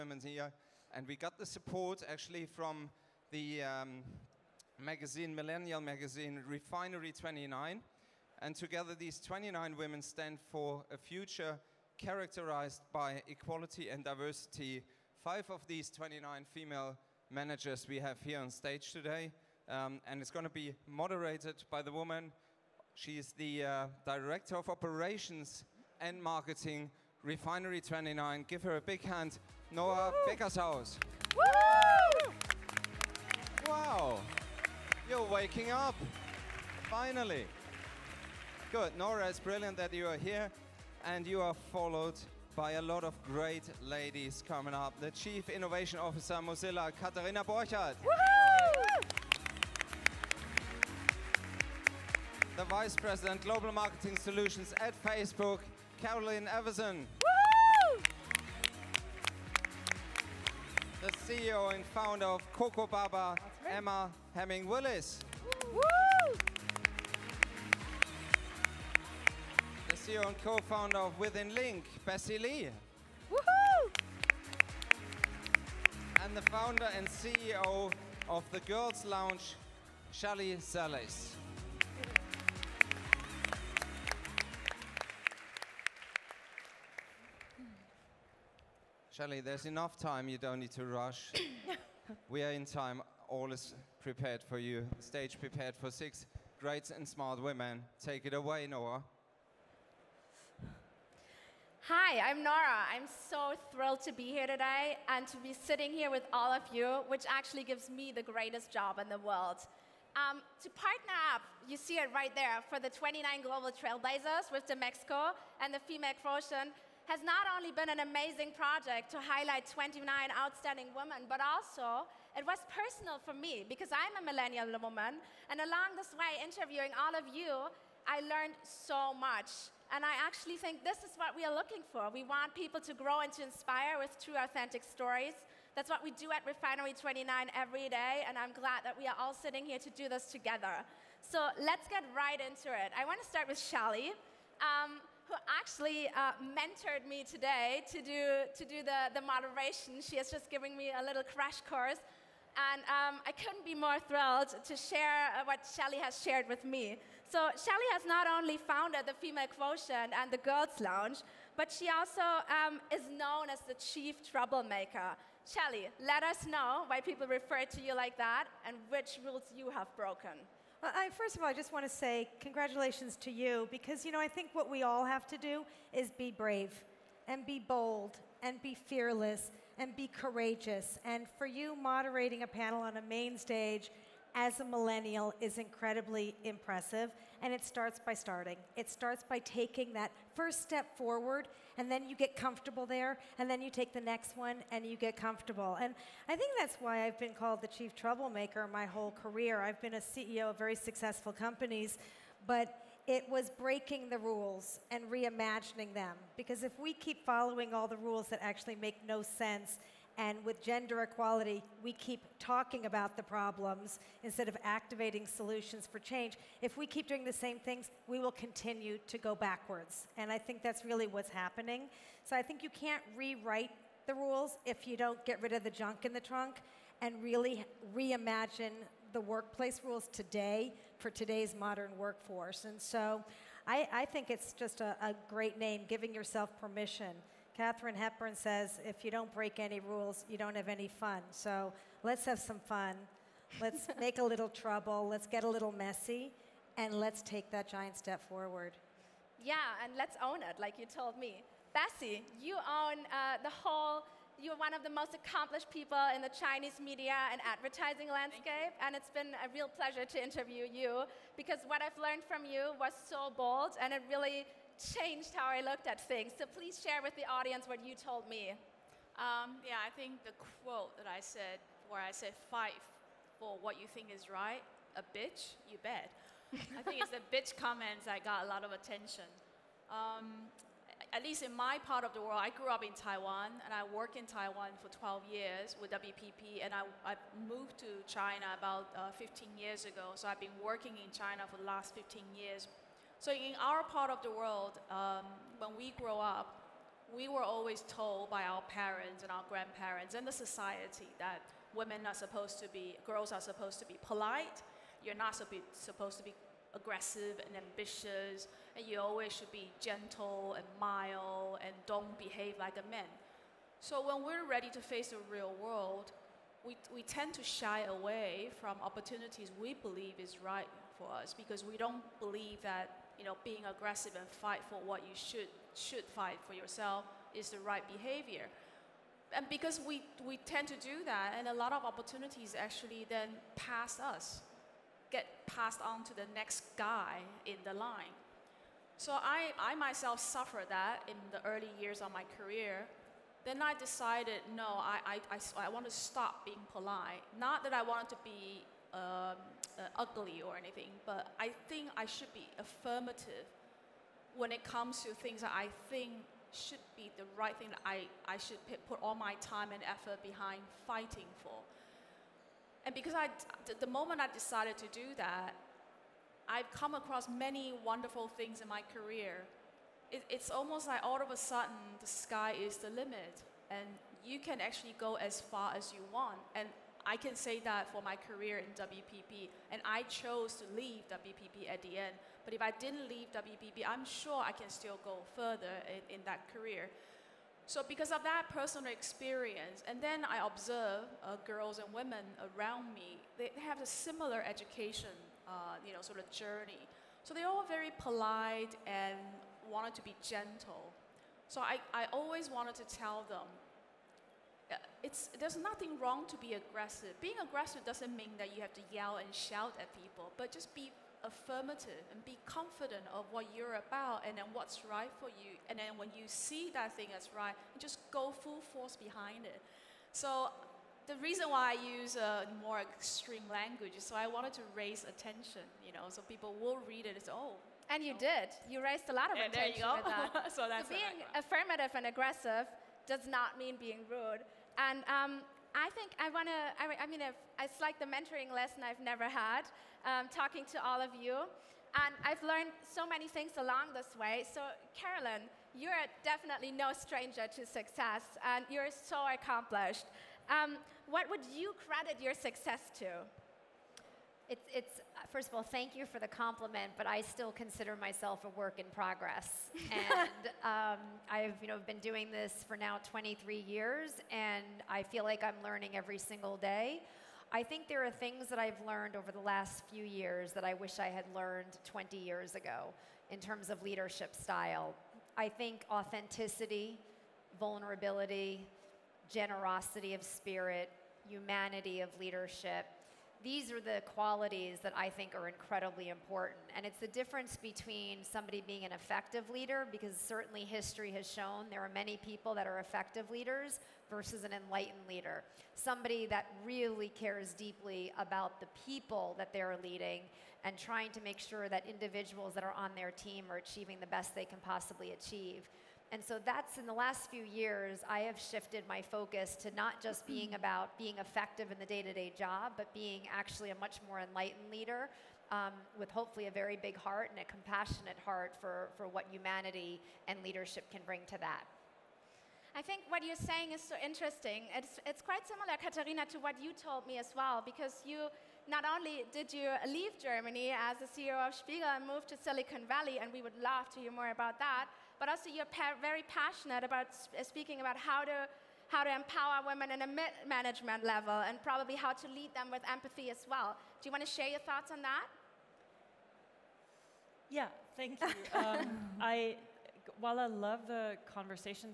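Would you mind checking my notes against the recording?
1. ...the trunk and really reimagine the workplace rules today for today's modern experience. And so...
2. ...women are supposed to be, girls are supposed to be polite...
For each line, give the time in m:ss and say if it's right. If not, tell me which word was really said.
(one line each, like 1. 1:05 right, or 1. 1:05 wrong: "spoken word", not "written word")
1. 3:46 wrong: "workforce", not "experience"
2. 5:01 right.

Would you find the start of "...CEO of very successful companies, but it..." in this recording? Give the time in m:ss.
3:20.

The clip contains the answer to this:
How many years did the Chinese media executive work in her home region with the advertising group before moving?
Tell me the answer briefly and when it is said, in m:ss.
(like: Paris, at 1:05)
12, at 4:44.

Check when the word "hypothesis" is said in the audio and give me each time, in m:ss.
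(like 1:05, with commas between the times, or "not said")
not said.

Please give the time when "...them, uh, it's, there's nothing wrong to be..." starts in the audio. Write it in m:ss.
6:43.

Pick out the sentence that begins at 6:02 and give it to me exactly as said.
And because I, the moment I decided to do that, I've come across many wonderful things in my career.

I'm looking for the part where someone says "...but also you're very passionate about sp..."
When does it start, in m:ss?
8:55.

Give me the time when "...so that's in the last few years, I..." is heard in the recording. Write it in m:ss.
8:26.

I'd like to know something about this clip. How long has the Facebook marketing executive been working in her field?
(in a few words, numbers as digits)
23 years.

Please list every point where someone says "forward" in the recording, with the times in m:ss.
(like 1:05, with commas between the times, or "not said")
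3:10, 4:08.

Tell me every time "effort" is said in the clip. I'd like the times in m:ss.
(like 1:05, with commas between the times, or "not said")
5:59.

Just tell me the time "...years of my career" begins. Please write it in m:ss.
5:41.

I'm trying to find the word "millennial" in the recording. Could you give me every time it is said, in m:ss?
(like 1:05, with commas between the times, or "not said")
0:05, 2:04, 3:04.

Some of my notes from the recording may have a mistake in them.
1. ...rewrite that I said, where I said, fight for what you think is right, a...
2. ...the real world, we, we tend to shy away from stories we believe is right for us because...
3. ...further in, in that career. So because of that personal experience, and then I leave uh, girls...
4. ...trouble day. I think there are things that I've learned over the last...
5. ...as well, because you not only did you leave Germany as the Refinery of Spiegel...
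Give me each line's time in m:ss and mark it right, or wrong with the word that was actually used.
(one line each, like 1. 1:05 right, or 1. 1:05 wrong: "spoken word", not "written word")
1. 4:30 wrong: "quote", not "rewrite"
2. 5:15 wrong: "opportunities", not "stories"
3. 6:25 wrong: "observe", not "leave"
4. 7:46 wrong: "single", not "trouble"
5. 8:47 wrong: "CEO", not "Refinery".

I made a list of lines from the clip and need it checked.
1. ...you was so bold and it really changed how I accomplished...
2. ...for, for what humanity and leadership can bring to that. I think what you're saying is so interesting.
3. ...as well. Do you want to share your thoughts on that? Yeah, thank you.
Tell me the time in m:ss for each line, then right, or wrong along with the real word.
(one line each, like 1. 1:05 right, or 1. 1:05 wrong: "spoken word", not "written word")
1. 4:22 wrong: "looked", not "accomplished"
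2. 8:38 right
3. 9:03 right.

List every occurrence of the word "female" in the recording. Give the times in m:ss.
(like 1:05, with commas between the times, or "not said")
0:16, 1:55, 2:39.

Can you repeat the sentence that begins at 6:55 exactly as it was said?
And then when you see that thing as right, just go full force behind it.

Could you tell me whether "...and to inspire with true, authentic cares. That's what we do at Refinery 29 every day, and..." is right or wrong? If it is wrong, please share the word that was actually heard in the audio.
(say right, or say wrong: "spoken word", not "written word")
wrong: "stories", not "cares".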